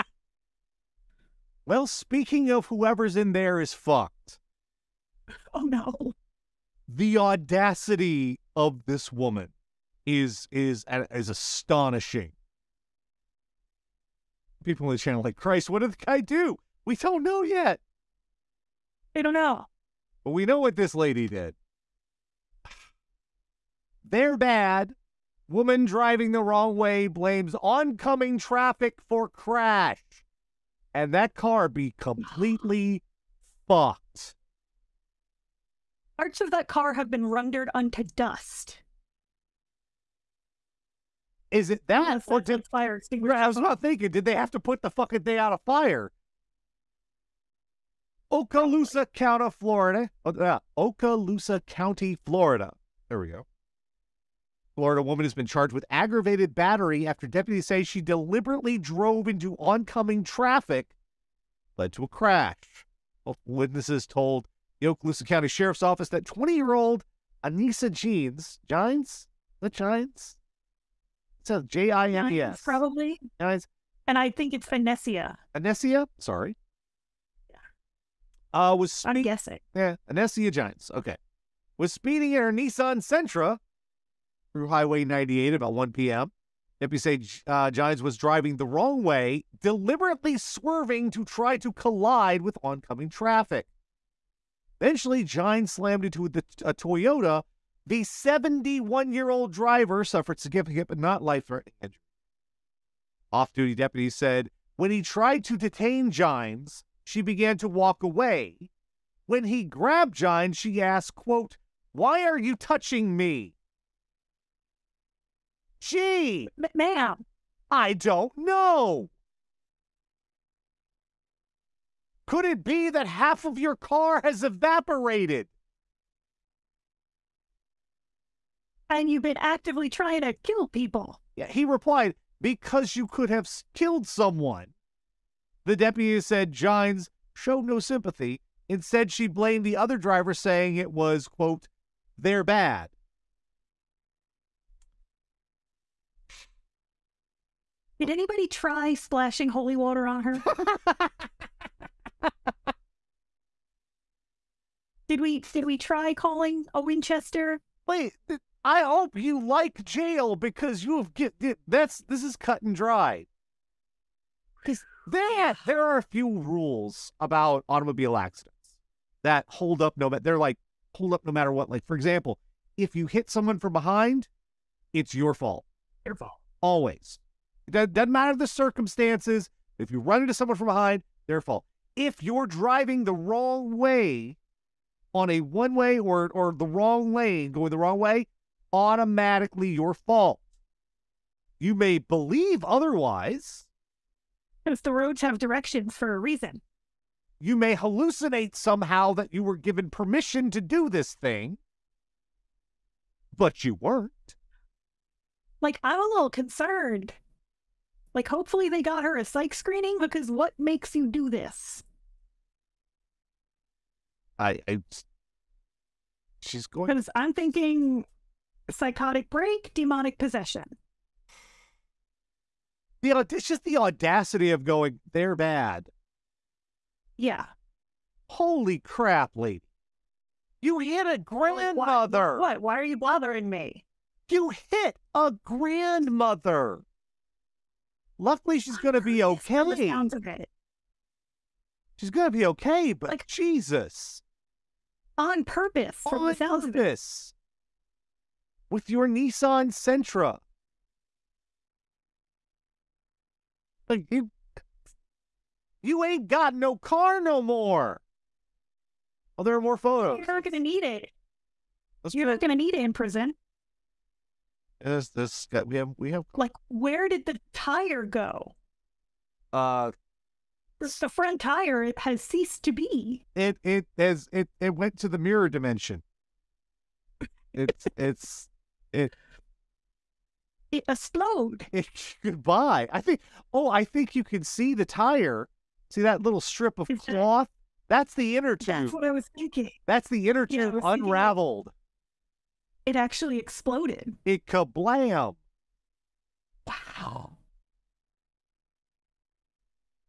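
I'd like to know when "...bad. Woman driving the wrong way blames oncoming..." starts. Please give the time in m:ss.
0:24.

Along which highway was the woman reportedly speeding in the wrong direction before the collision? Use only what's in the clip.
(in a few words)
Highway 98.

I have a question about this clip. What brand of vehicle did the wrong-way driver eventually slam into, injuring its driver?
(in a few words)
Toyota.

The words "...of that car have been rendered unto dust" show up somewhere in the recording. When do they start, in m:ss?
0:36.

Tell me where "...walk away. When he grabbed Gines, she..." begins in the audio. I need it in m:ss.
1:47.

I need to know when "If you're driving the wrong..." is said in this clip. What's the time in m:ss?
3:01.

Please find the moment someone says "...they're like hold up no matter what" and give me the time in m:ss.
2:50.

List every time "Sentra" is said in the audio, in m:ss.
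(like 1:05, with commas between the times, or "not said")
1:22, 4:09.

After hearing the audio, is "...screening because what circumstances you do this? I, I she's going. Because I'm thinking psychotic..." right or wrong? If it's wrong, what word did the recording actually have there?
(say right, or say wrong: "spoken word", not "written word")
wrong: "makes", not "circumstances".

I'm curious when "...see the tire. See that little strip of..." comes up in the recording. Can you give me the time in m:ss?
4:44.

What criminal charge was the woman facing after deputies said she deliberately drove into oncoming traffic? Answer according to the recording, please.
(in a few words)
aggravated battery.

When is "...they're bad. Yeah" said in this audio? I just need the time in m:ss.
3:45.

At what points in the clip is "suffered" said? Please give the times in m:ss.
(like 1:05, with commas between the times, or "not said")
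1:40.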